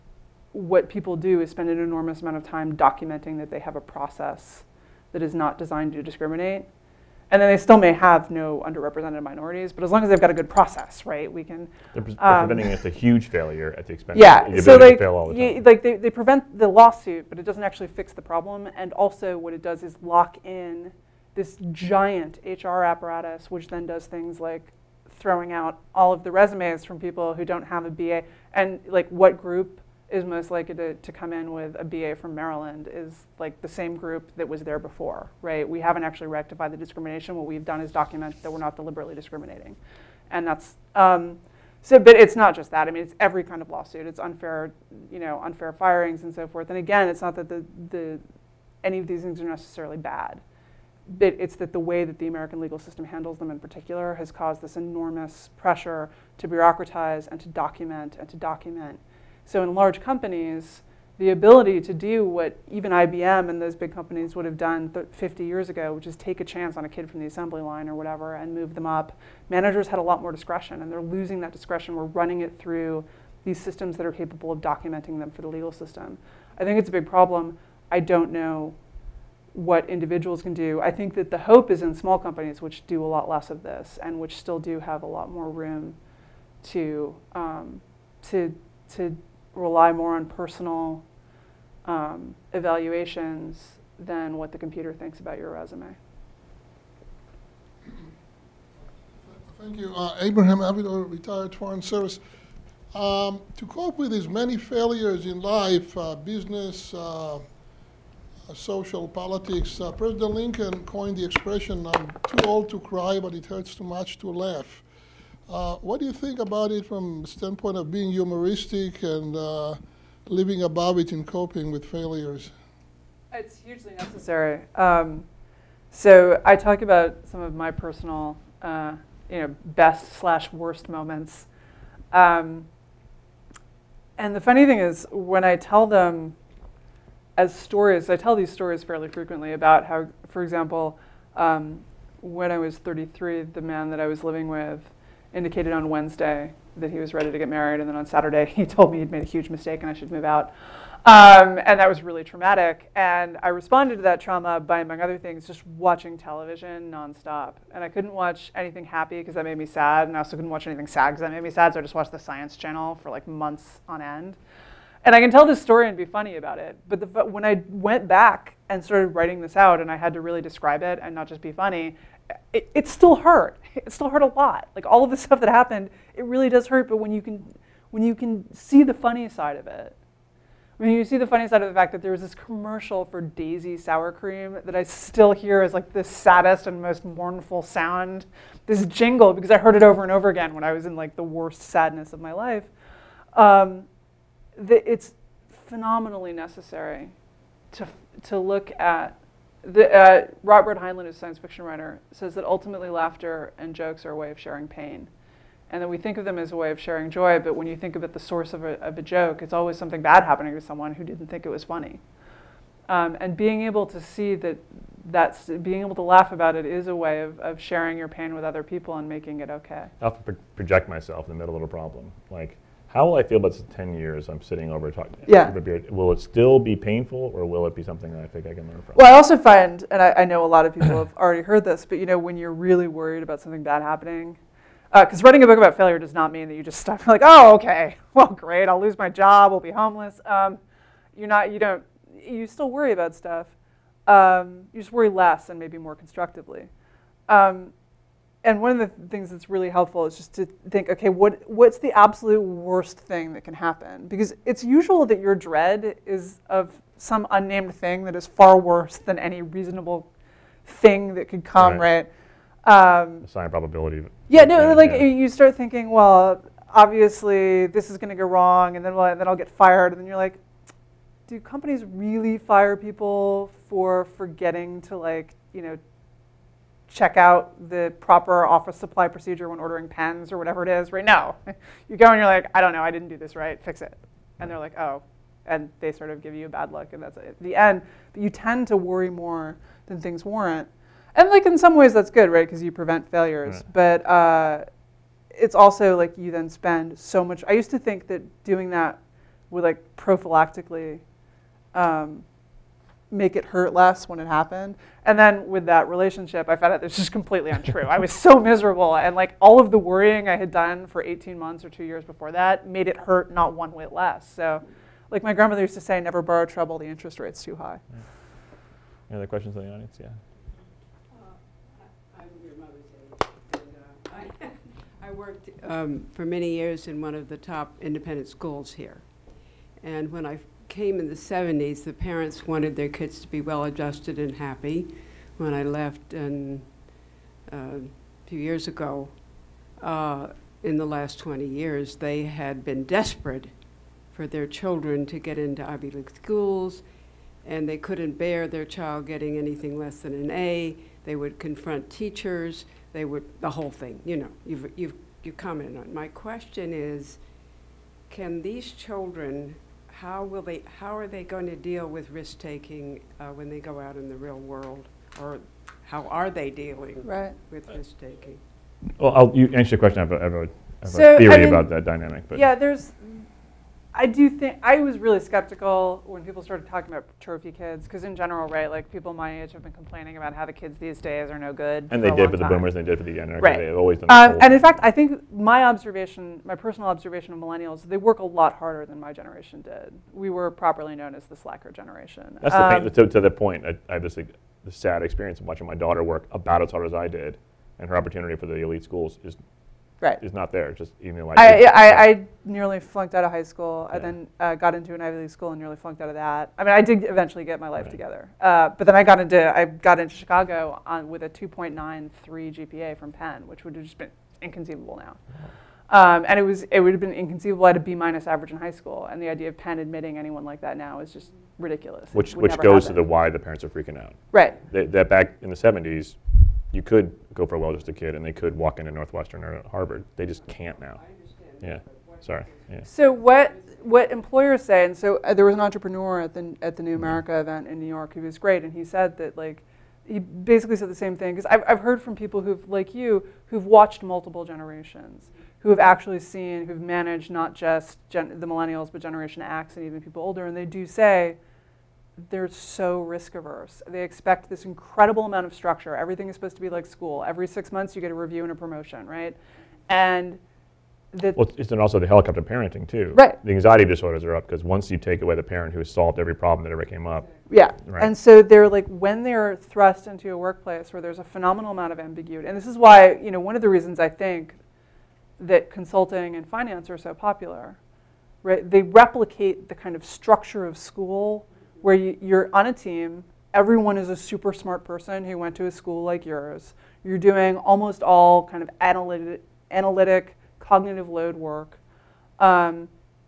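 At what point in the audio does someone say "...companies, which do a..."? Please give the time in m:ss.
1:22.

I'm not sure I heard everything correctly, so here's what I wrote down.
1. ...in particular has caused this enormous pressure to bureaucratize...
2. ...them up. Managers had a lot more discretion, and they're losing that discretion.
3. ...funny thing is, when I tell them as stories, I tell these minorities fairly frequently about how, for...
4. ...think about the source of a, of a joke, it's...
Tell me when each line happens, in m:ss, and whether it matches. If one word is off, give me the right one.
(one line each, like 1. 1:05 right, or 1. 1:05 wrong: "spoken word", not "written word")
1. 0:53 right
2. 1:08 right
3. 2:14 wrong: "stories", not "minorities"
4. 3:27 right.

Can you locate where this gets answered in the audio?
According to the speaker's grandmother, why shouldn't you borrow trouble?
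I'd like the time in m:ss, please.
5:16.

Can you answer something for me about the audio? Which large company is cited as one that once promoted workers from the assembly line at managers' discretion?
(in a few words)
IBM.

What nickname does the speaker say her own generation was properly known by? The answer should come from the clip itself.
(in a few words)
Slacker generation.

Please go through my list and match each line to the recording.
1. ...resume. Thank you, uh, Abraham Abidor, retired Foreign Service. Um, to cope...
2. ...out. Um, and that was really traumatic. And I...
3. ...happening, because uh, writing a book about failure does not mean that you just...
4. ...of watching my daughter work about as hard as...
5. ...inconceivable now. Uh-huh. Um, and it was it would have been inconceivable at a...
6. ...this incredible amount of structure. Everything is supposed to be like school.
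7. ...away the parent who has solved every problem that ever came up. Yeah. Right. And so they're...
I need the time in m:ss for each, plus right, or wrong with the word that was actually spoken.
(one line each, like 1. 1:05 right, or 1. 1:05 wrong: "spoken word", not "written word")
1. 1:35 right
2. 2:30 right
3. 3:53 right
4. 6:35 right
5. 6:54 right
6. 7:34 right
7. 7:45 right.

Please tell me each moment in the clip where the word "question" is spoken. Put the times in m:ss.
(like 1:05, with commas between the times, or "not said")
5:19, 5:56, 6:09.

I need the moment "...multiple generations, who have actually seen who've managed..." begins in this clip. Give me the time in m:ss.
7:24.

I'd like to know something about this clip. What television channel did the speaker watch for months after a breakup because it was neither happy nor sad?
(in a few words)
Science Channel.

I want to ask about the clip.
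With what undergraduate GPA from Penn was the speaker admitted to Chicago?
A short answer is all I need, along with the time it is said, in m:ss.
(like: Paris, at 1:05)
2.93, at 6:51.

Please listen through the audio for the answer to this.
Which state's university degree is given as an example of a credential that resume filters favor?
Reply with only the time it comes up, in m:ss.
0:32.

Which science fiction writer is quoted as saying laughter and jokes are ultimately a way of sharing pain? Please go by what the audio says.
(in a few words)
Robert Heinlein.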